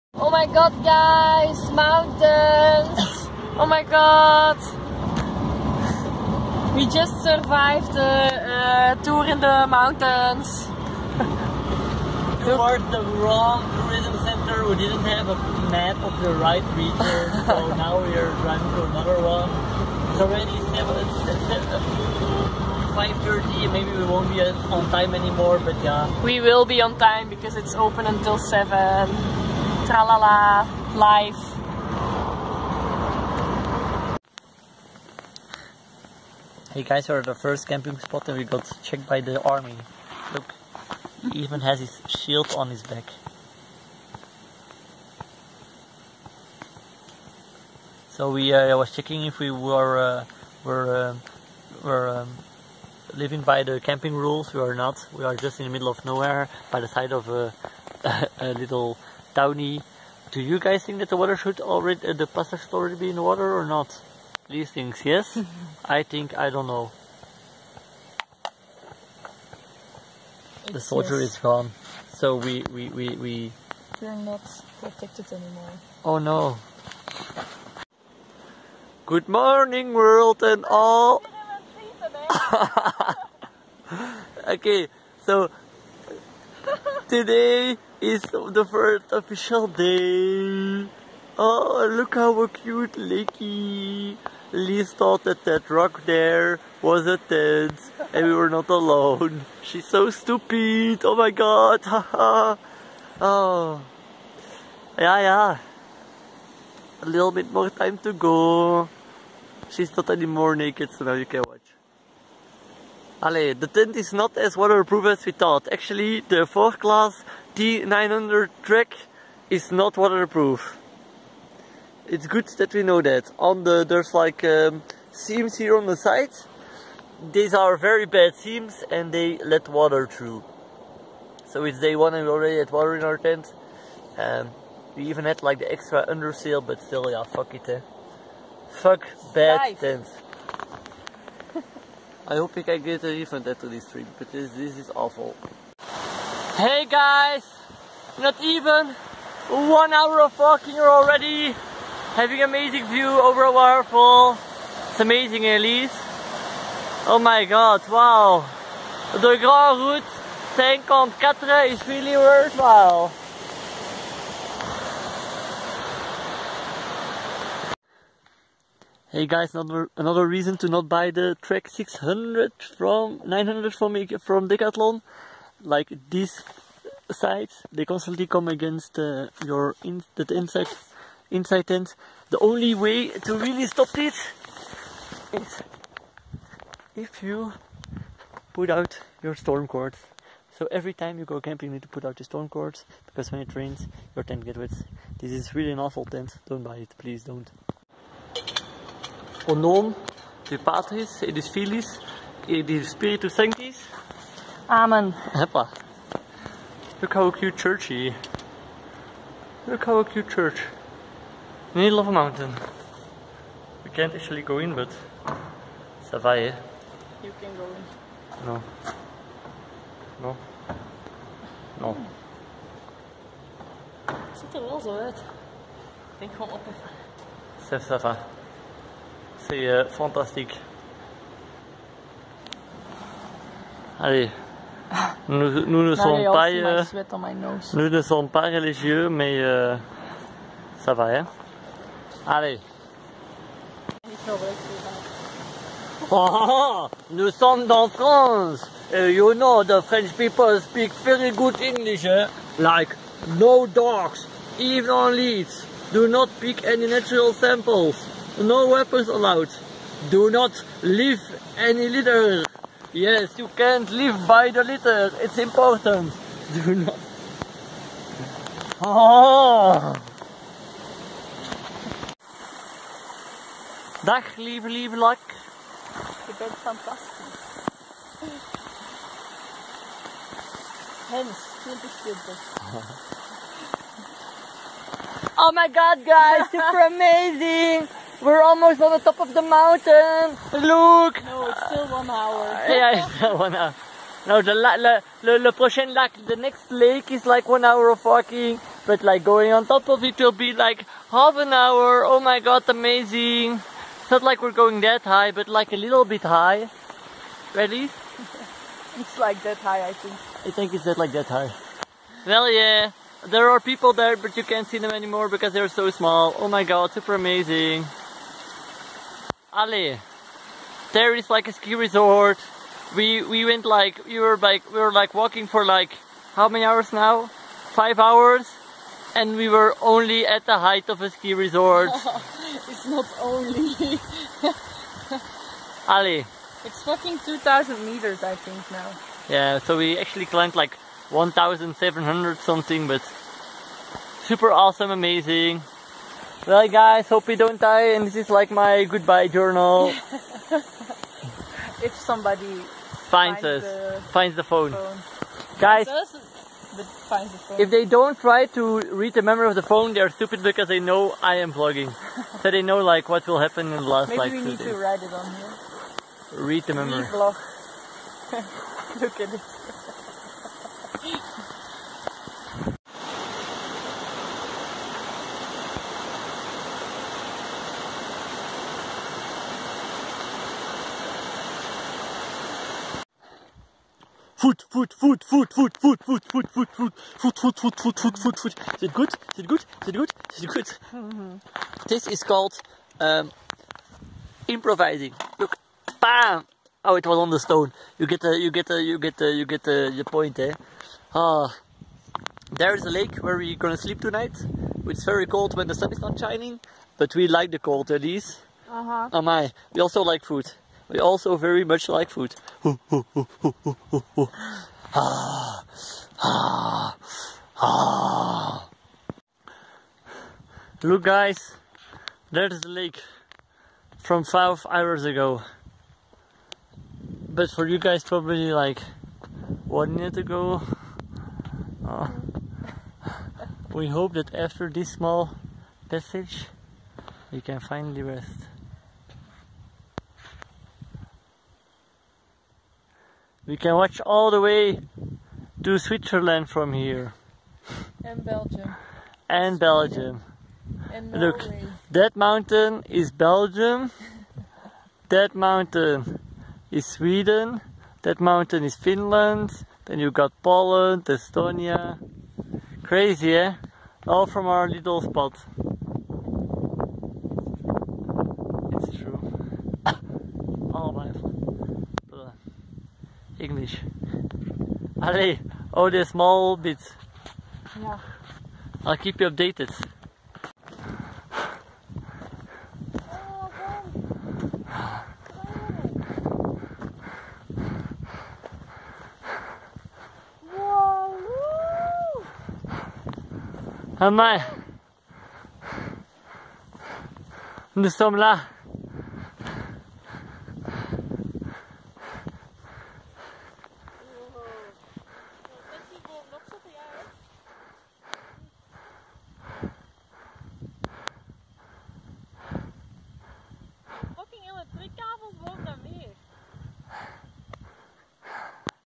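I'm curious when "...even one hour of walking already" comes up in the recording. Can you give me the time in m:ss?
2:28.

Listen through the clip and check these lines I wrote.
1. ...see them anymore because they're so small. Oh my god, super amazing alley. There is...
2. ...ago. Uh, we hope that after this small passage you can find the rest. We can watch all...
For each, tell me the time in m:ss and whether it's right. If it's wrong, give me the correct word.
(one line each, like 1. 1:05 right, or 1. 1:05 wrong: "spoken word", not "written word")
1. 5:14 right
2. 7:10 right.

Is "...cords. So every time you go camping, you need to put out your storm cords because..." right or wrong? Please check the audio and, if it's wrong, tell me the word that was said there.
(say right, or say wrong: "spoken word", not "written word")
right.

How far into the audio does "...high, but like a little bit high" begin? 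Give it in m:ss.
5:05.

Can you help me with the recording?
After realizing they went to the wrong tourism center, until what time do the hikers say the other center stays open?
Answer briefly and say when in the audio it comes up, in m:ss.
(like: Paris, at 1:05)
7, at 0:27.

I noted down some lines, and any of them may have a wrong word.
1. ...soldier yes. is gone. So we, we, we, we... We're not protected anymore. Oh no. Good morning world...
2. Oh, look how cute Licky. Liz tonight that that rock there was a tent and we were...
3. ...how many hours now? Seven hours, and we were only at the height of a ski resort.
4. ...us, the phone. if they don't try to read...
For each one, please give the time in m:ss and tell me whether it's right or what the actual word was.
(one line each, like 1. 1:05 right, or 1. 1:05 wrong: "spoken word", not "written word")
1. 1:10 right
2. 1:31 wrong: "thought", not "tonight"
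3. 5:26 wrong: "Five", not "Seven"
4. 5:55 right.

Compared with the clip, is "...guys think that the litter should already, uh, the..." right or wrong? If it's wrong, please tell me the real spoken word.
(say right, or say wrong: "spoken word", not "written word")
wrong: "water", not "litter".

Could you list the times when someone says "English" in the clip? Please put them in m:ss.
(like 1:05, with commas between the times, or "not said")
4:11, 7:53.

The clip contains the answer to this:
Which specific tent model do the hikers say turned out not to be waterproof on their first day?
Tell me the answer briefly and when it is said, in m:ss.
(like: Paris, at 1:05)
Forclaz T900, at 1:56.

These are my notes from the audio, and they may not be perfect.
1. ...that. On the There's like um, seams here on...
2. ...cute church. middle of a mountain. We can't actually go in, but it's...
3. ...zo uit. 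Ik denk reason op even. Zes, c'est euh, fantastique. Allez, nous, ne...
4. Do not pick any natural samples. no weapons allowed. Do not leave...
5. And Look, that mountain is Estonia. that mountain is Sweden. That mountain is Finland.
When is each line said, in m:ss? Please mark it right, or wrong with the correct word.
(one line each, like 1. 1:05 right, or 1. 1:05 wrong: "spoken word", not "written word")
1. 2:03 right
2. 3:30 right
3. 3:44 wrong: "gewoon", not "reason"
4. 4:15 right
5. 7:30 wrong: "Belgium", not "Estonia".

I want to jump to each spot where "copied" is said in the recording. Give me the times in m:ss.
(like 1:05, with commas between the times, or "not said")
not said.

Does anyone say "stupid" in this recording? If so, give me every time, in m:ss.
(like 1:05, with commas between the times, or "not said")
1:40, 6:00.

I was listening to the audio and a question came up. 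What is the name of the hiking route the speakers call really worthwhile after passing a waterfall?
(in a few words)
grand route 5.4.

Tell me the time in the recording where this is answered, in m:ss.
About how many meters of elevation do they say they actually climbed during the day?
5:41.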